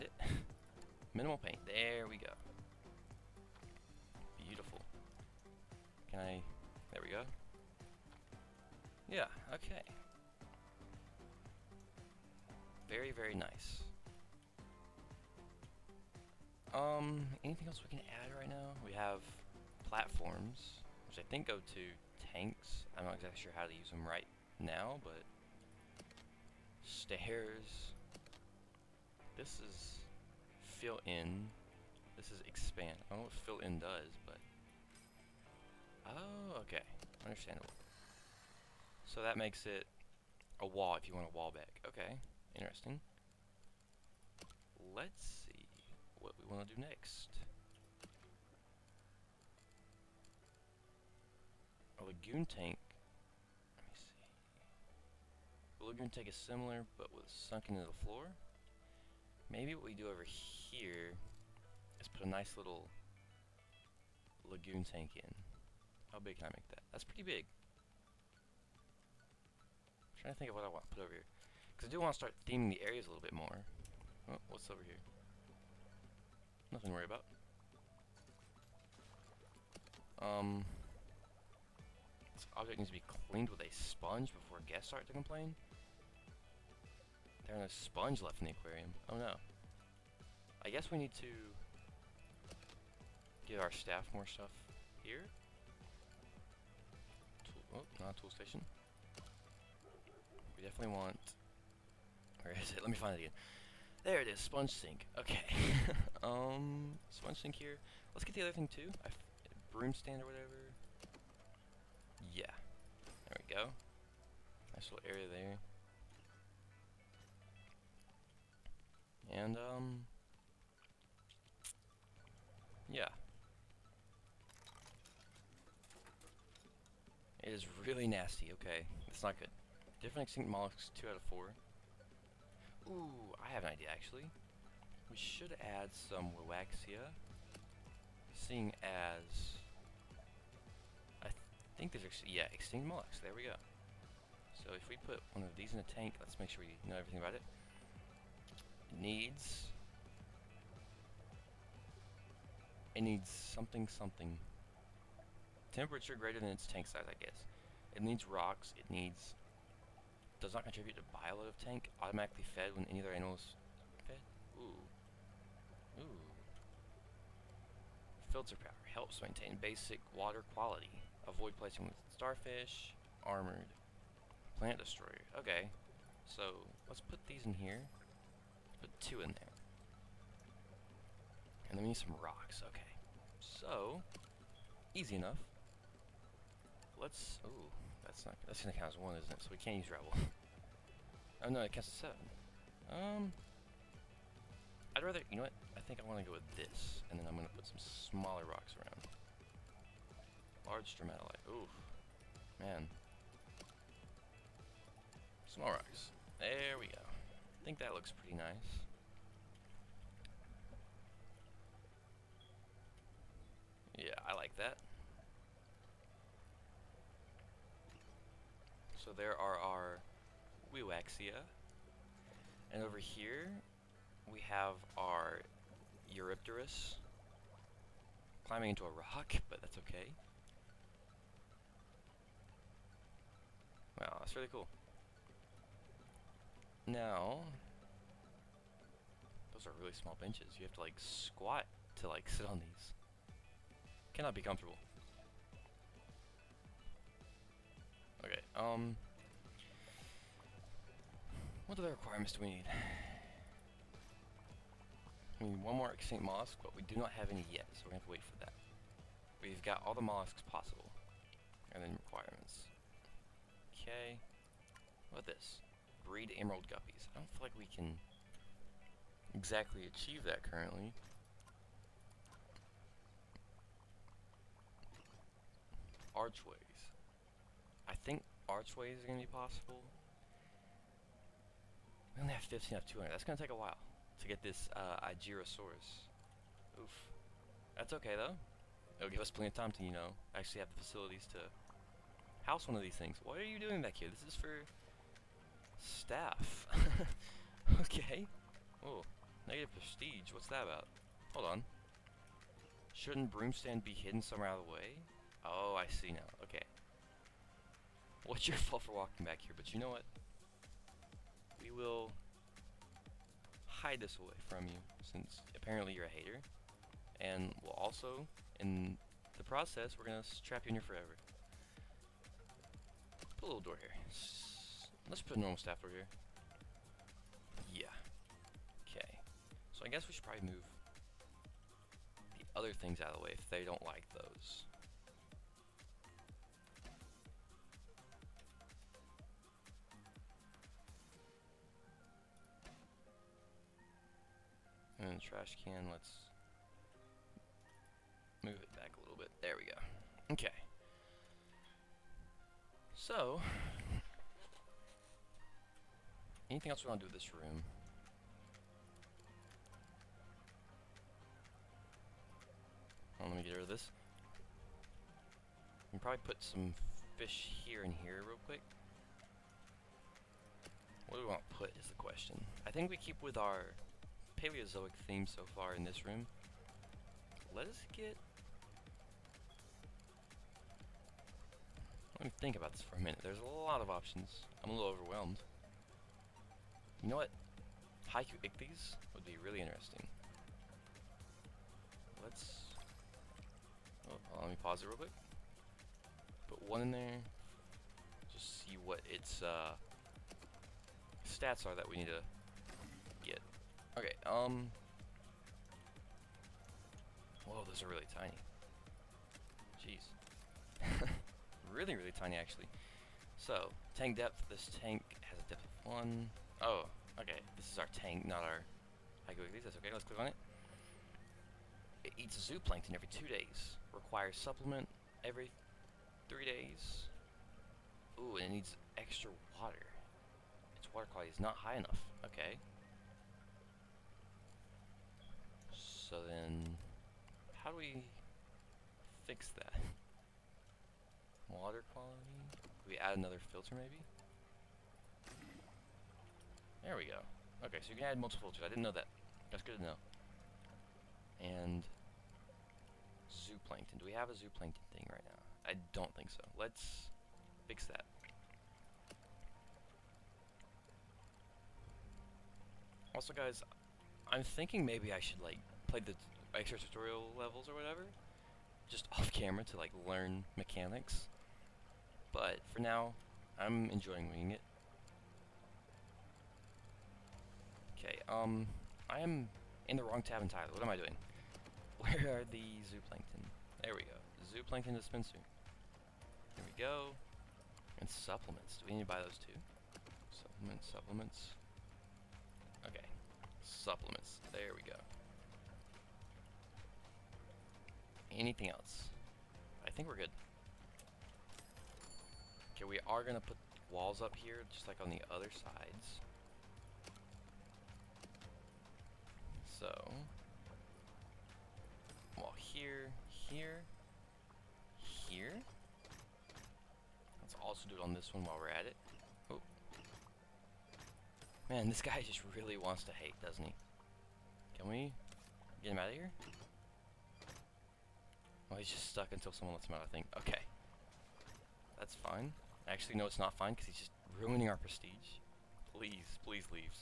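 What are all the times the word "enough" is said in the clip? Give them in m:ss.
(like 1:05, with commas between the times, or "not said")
3:05, 7:11.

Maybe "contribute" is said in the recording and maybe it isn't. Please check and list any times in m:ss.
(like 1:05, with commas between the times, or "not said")
2:40.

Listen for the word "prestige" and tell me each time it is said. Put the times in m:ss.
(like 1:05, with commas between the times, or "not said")
4:59, 8:54.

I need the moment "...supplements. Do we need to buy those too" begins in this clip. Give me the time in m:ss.
8:08.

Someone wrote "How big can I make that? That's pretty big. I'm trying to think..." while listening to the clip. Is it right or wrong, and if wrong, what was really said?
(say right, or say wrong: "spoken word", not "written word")
right.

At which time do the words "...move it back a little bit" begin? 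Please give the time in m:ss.
5:48.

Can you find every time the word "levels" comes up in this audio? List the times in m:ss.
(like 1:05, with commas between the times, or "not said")
7:47.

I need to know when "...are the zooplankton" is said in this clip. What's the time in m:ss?
8:02.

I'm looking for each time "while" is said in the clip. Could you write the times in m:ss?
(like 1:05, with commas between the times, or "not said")
4:43, 8:38.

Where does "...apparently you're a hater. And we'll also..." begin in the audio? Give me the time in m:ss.
5:15.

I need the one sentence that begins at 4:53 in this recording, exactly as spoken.
What are you doing back here?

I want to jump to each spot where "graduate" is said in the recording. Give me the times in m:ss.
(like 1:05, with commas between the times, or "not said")
not said.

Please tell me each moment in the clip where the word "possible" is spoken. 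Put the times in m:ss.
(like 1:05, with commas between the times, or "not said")
4:20, 4:39.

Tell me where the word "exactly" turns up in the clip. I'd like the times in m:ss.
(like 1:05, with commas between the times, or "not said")
0:23, 4:29.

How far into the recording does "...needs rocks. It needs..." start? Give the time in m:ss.
2:38.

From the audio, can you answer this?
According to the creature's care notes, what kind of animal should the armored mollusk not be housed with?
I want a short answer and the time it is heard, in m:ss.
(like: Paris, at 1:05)
Starfish, at 2:52.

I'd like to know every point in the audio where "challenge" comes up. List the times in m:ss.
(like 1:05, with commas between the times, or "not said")
not said.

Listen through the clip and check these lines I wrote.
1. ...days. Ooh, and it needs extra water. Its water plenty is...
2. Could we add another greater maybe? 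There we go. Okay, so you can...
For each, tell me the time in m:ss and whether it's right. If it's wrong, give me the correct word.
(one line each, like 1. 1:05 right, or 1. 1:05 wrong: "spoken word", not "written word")
1. 7:06 wrong: "quality", not "plenty"
2. 7:22 wrong: "filter", not "greater".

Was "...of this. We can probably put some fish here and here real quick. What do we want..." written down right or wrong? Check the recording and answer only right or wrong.
right.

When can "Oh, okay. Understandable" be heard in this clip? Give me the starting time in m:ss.
0:36.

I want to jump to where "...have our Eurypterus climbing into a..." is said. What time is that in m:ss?
3:44.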